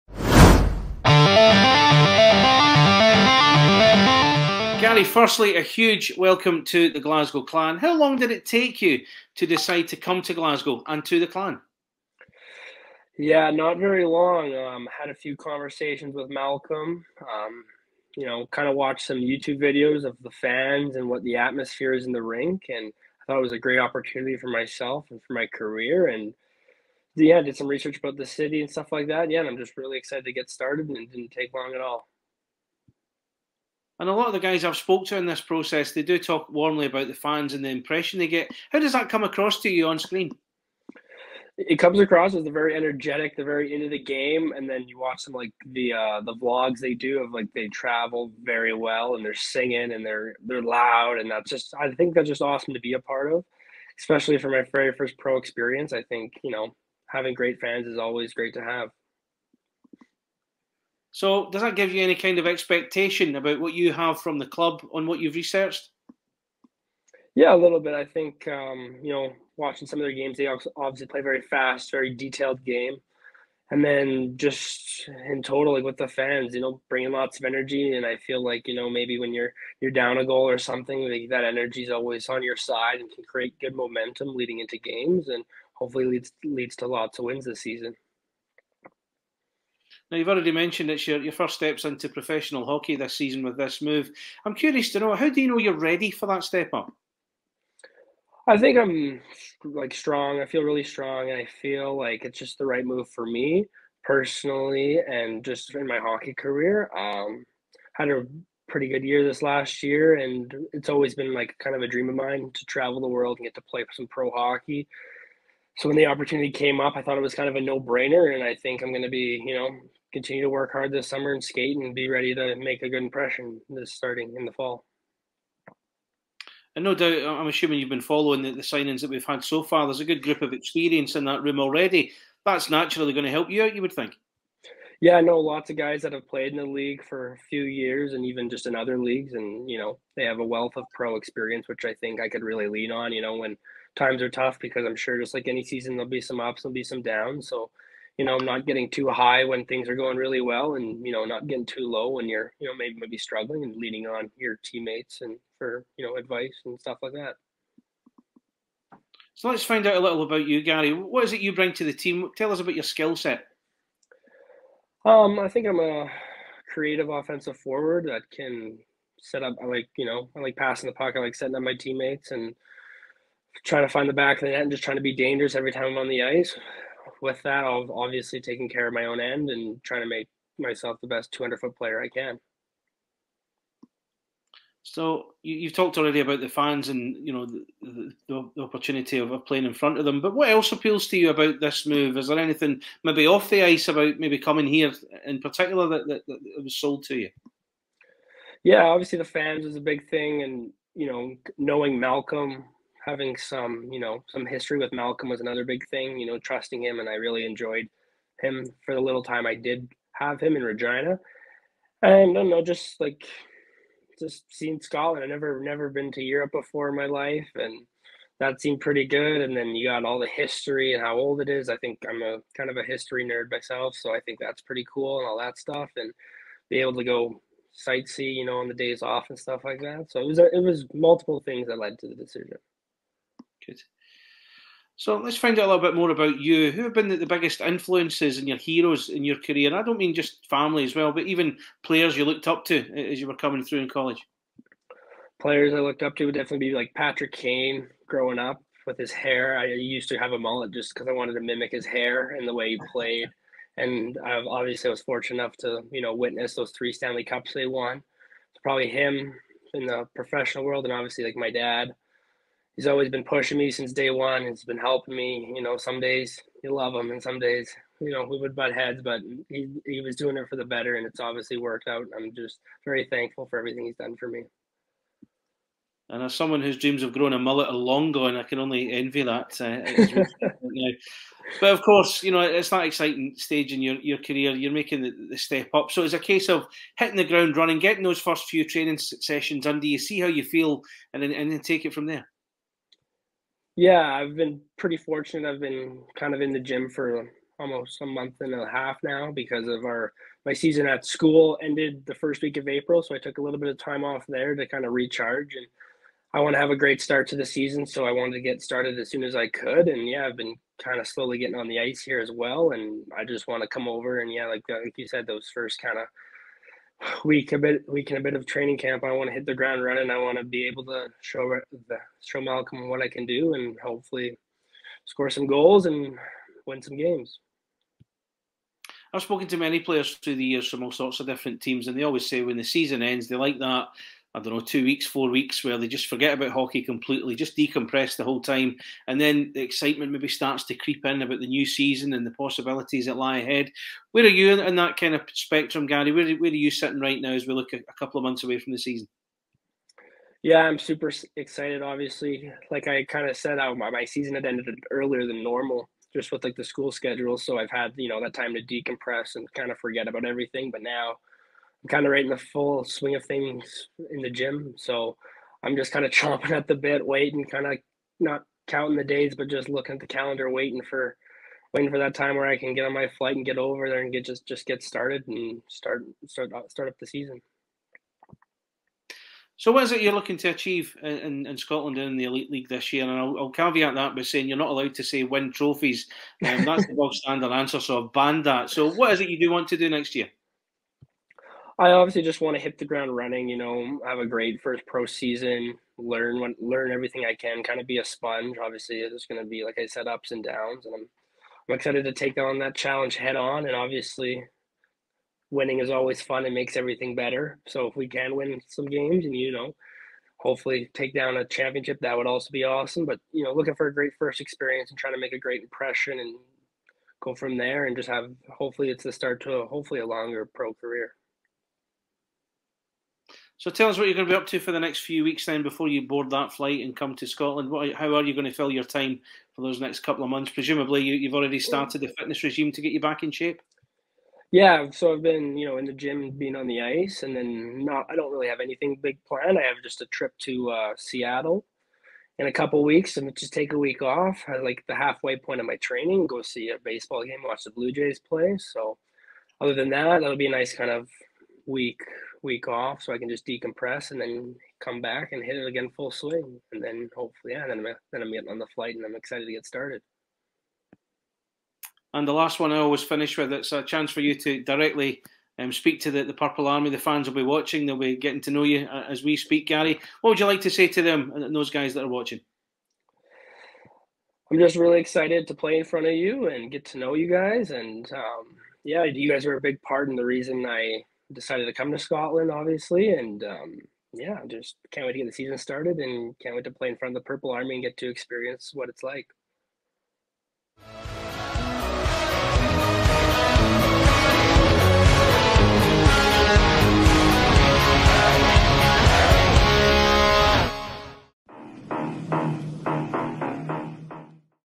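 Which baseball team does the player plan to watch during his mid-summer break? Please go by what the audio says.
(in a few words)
Blue Jays.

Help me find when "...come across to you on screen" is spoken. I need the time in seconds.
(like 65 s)
39 s.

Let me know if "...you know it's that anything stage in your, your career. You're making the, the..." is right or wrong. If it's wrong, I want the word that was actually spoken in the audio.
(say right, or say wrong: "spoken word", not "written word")
wrong: "exciting", not "anything".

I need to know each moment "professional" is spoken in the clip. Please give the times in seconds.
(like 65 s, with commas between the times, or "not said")
92 s, 260 s.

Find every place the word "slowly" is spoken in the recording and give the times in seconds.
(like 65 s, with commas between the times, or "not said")
311 s.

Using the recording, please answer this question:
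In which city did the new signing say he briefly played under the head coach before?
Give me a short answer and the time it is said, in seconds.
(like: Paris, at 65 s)
Regina, at 210 s.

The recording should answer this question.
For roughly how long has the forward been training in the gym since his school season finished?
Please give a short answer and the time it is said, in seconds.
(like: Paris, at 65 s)
A month and a half, at 298 s.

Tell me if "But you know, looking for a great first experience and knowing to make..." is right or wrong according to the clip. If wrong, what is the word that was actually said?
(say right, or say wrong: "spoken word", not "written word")
wrong: "trying", not "knowing".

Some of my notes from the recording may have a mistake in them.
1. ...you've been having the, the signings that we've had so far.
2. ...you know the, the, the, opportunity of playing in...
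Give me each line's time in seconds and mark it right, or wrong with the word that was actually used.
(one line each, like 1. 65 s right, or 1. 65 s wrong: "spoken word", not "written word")
1. 127 s wrong: "following", not "having"
2. 187 s right.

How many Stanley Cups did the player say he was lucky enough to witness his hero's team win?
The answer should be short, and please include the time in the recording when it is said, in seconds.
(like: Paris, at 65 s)
3, at 256 s.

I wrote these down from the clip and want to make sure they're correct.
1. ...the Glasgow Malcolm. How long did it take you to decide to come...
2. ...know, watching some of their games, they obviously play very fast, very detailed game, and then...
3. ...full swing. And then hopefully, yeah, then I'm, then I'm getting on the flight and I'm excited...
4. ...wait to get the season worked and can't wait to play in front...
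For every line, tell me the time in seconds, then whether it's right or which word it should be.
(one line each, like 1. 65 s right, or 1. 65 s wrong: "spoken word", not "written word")
1. 6 s wrong: "Clan", not "Malcolm"
2. 69 s right
3. 455 s right
4. 485 s wrong: "started", not "worked".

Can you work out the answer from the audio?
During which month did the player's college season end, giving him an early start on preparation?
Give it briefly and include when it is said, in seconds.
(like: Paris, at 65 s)
April, at 302 s.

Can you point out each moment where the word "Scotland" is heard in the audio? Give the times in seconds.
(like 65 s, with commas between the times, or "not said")
214 s, 381 s, 427 s, 481 s.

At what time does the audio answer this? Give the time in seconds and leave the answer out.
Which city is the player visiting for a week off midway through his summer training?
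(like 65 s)
440 s.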